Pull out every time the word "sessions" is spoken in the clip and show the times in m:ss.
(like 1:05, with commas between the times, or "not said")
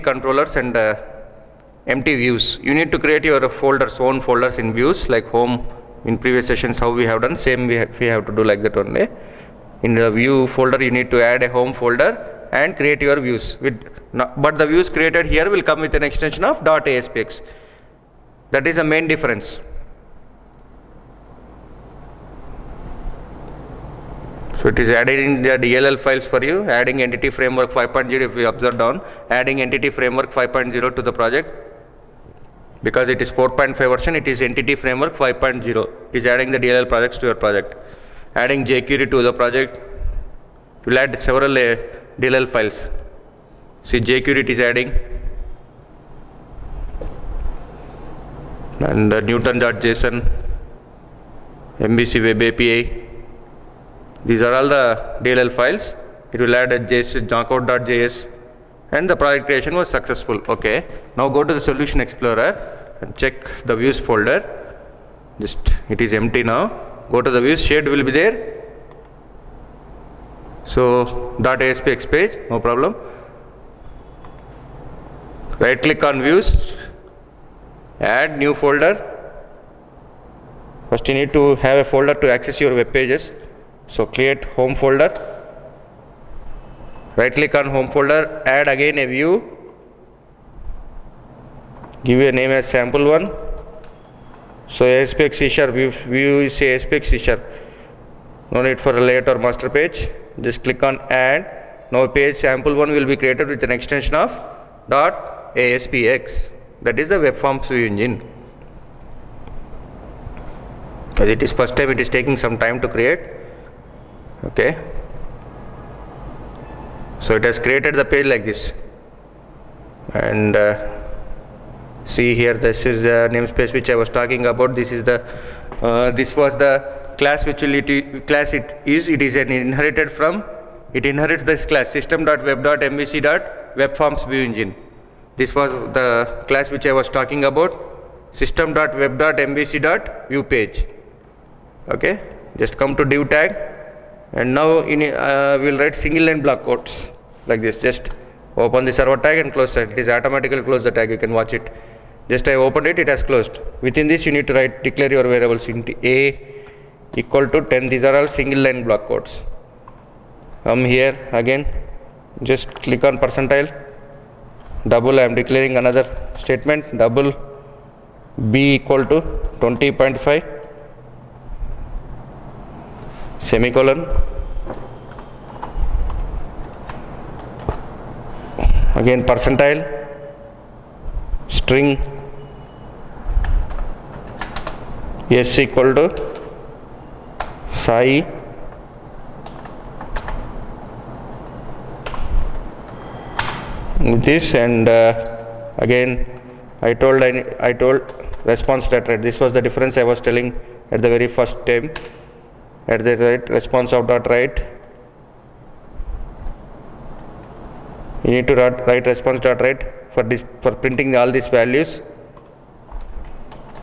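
0:06.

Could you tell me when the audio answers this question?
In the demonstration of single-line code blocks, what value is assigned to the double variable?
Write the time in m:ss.
2:49.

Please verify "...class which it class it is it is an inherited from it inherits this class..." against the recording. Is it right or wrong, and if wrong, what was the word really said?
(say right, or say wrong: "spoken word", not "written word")
right.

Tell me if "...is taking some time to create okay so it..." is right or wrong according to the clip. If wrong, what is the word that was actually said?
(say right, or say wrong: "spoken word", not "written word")
right.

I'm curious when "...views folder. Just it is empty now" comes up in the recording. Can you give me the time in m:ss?
1:03.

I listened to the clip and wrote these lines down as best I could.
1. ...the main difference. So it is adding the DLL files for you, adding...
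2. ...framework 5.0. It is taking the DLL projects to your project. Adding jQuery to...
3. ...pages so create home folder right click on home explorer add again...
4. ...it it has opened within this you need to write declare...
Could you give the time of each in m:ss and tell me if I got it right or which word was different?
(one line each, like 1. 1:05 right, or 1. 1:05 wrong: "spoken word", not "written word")
1. 0:18 right
2. 0:34 wrong: "adding", not "taking"
3. 1:22 wrong: "folder", not "explorer"
4. 2:32 wrong: "closed", not "opened".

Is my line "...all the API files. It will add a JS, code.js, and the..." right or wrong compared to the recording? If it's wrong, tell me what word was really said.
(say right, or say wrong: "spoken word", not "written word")
wrong: "DLL", not "API".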